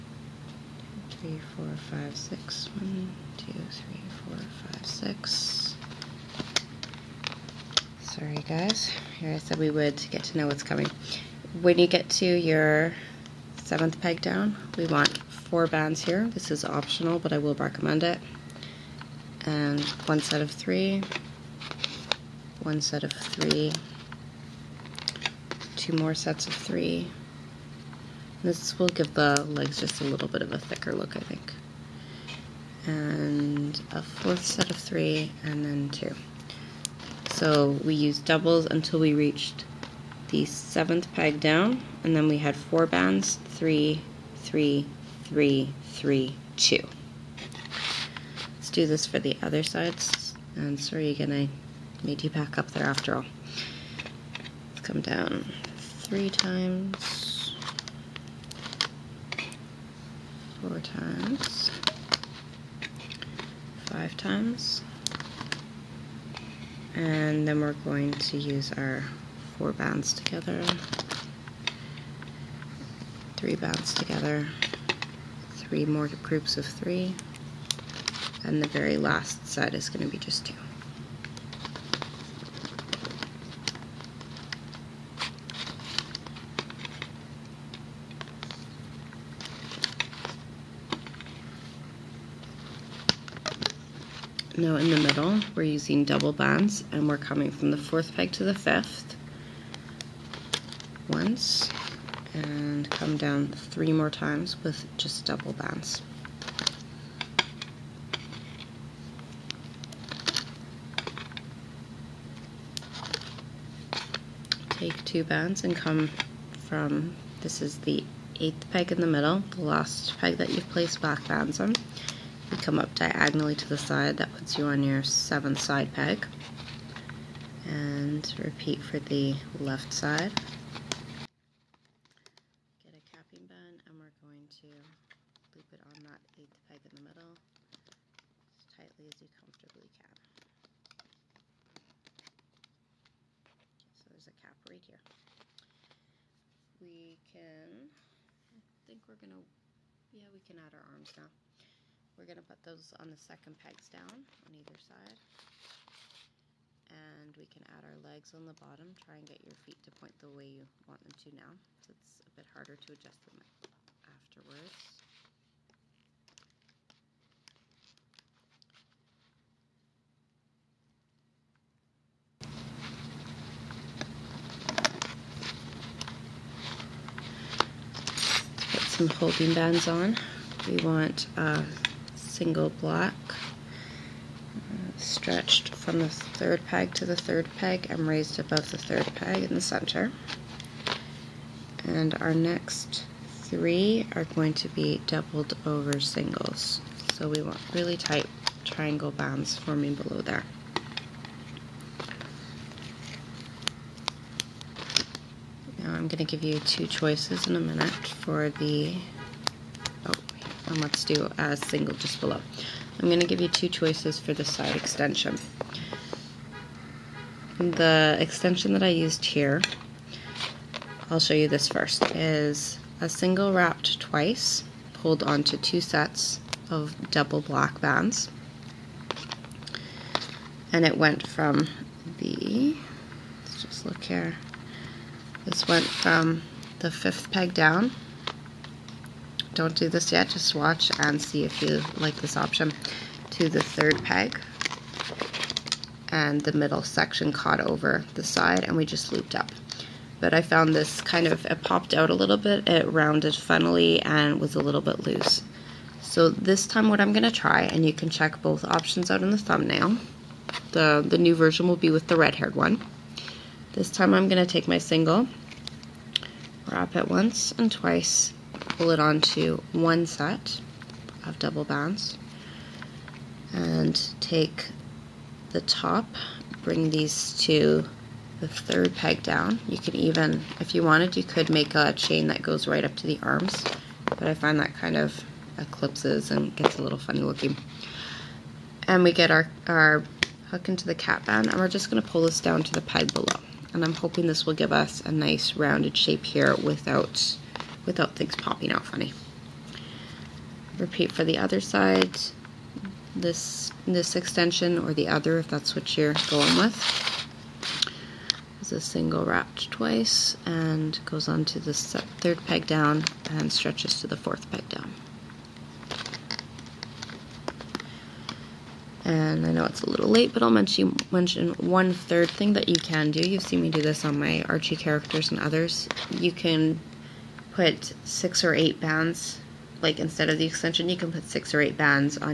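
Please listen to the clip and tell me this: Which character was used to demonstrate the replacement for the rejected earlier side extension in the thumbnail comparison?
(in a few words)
the red haired one.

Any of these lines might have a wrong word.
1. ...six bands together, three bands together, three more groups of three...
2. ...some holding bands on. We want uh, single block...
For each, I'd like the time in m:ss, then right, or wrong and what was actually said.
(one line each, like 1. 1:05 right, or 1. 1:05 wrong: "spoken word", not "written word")
1. 1:09 wrong: "four", not "six"
2. 2:58 right.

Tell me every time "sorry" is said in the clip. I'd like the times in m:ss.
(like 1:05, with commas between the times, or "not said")
0:08, 0:50.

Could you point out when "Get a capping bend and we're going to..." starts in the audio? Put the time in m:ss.
2:12.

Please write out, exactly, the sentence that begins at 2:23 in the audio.
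So there's a cap right here.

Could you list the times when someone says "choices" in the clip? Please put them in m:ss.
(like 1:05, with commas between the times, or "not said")
3:26, 3:33.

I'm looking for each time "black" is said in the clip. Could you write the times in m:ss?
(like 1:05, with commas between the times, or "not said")
2:00, 3:47.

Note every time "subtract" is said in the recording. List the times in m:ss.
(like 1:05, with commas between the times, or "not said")
not said.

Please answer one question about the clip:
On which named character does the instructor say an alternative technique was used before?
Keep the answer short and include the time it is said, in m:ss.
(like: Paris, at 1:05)
Archie, at 5:24.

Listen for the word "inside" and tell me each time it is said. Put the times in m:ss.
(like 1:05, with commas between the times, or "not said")
not said.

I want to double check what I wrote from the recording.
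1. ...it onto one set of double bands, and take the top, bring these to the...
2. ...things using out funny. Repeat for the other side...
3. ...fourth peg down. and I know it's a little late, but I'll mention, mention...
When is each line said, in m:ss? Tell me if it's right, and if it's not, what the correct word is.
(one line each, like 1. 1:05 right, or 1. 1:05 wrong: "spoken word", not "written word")
1. 4:28 right
2. 4:58 wrong: "popping", not "using"
3. 5:14 right.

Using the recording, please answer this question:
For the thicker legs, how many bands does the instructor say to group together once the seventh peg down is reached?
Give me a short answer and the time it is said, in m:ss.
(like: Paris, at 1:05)
4, at 0:15.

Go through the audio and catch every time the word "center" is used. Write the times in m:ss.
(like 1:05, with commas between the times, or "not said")
3:09.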